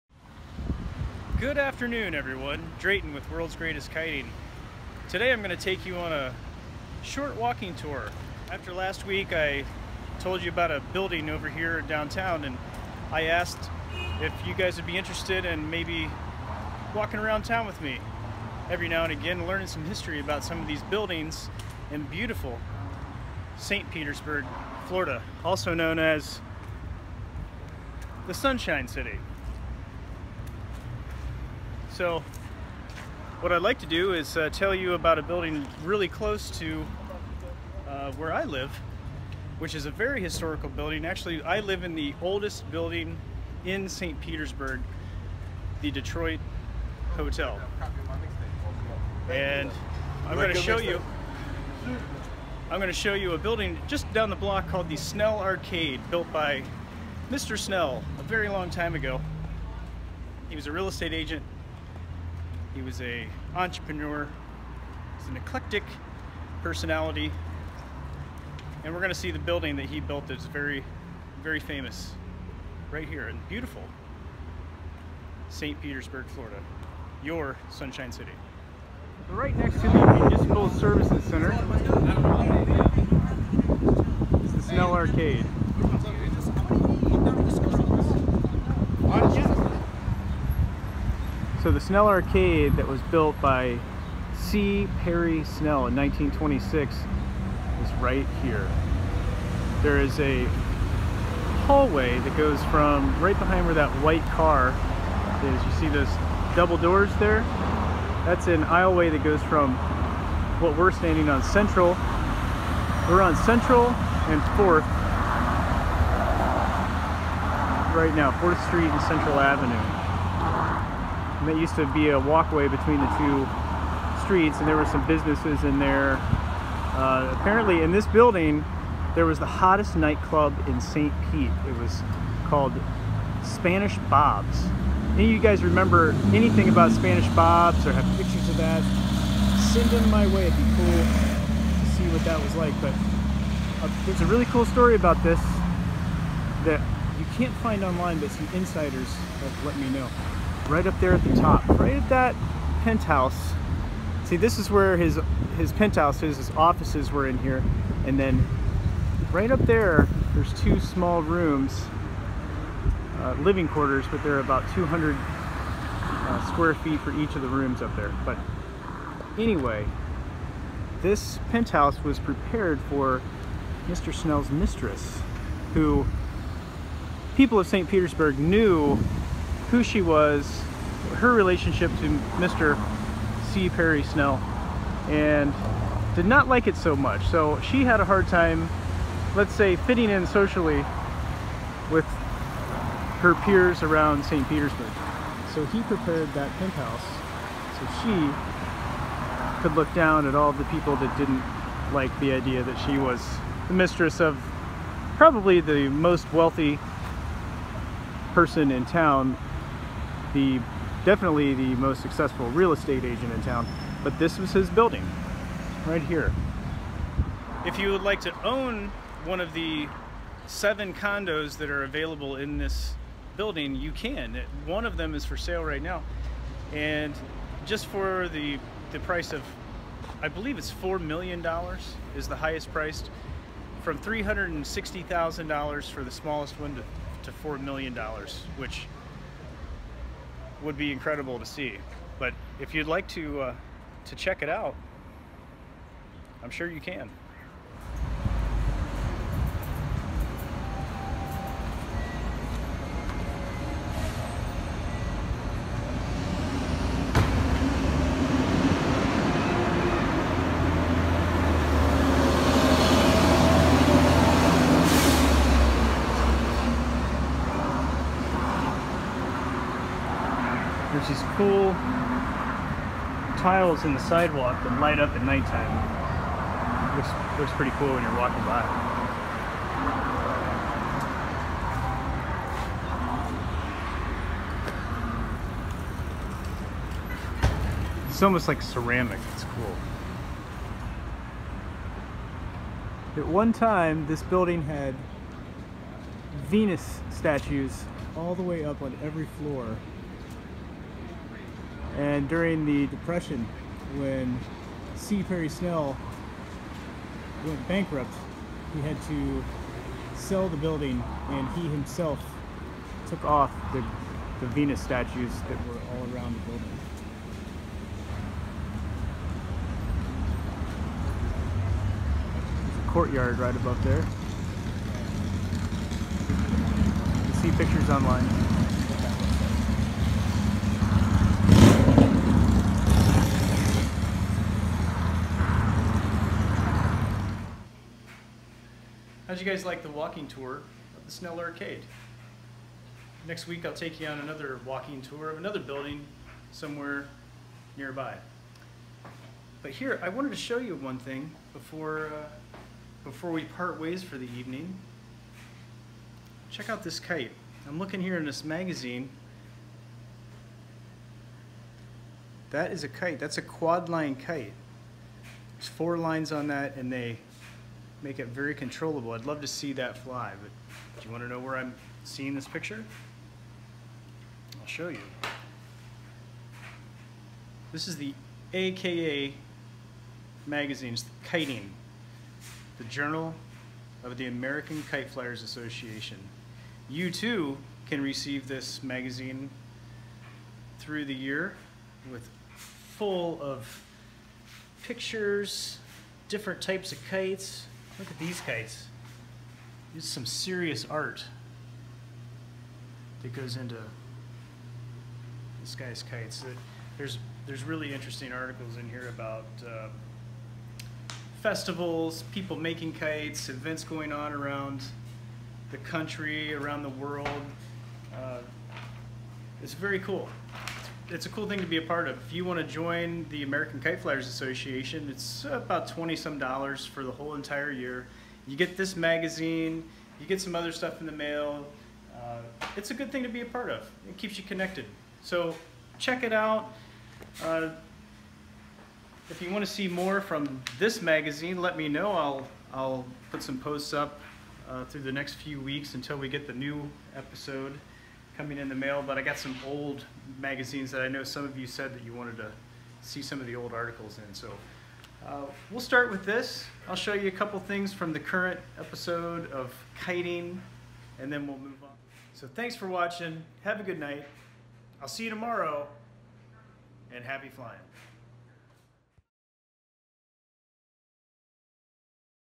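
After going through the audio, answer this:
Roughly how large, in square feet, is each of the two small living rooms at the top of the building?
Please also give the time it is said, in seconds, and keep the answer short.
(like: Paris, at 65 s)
200, at 164 s.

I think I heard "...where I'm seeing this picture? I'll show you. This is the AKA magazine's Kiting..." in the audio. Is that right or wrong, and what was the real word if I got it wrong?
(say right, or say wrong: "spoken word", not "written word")
right.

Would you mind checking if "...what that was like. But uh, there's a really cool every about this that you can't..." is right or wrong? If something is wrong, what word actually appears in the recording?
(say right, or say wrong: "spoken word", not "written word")
wrong: "story", not "every".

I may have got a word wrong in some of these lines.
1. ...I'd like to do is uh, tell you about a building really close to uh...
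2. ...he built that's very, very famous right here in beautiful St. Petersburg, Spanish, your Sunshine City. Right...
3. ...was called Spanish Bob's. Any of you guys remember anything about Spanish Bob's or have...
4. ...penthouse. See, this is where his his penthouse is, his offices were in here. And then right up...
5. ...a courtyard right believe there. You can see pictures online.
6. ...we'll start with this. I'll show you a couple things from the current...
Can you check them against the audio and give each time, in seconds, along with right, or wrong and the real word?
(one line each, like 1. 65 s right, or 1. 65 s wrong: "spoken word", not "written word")
1. 33 s right
2. 69 s wrong: "Florida", not "Spanish"
3. 131 s right
4. 152 s right
5. 322 s wrong: "above", not "believe"
6. 455 s right.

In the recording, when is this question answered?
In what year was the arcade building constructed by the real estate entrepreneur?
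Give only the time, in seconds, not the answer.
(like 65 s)
95 s.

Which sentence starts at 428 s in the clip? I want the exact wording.
You get this magazine, you get some other stuff in the mail.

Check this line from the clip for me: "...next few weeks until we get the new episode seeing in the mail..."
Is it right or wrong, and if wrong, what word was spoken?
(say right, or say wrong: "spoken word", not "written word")
wrong: "coming", not "seeing".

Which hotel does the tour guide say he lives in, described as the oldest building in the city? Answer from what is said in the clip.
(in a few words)
Detroit Hotel.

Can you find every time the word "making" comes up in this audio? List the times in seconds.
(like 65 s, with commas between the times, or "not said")
412 s.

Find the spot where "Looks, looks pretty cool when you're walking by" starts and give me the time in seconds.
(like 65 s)
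276 s.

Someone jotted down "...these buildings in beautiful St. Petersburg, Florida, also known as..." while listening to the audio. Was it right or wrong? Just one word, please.
right.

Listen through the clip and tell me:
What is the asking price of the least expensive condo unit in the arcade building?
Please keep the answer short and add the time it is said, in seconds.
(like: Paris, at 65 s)
$360,000, at 233 s.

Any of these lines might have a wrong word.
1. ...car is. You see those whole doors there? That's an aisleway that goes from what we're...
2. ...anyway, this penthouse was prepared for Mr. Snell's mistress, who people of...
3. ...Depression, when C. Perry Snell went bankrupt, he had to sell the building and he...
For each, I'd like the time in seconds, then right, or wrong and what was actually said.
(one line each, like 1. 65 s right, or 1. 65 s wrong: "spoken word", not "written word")
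1. 104 s wrong: "double", not "whole"
2. 169 s right
3. 302 s right.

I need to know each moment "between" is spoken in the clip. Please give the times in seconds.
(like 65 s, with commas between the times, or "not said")
122 s.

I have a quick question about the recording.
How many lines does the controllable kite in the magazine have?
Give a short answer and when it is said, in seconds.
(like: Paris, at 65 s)
4, at 365 s.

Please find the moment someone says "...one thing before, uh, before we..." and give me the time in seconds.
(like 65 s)
350 s.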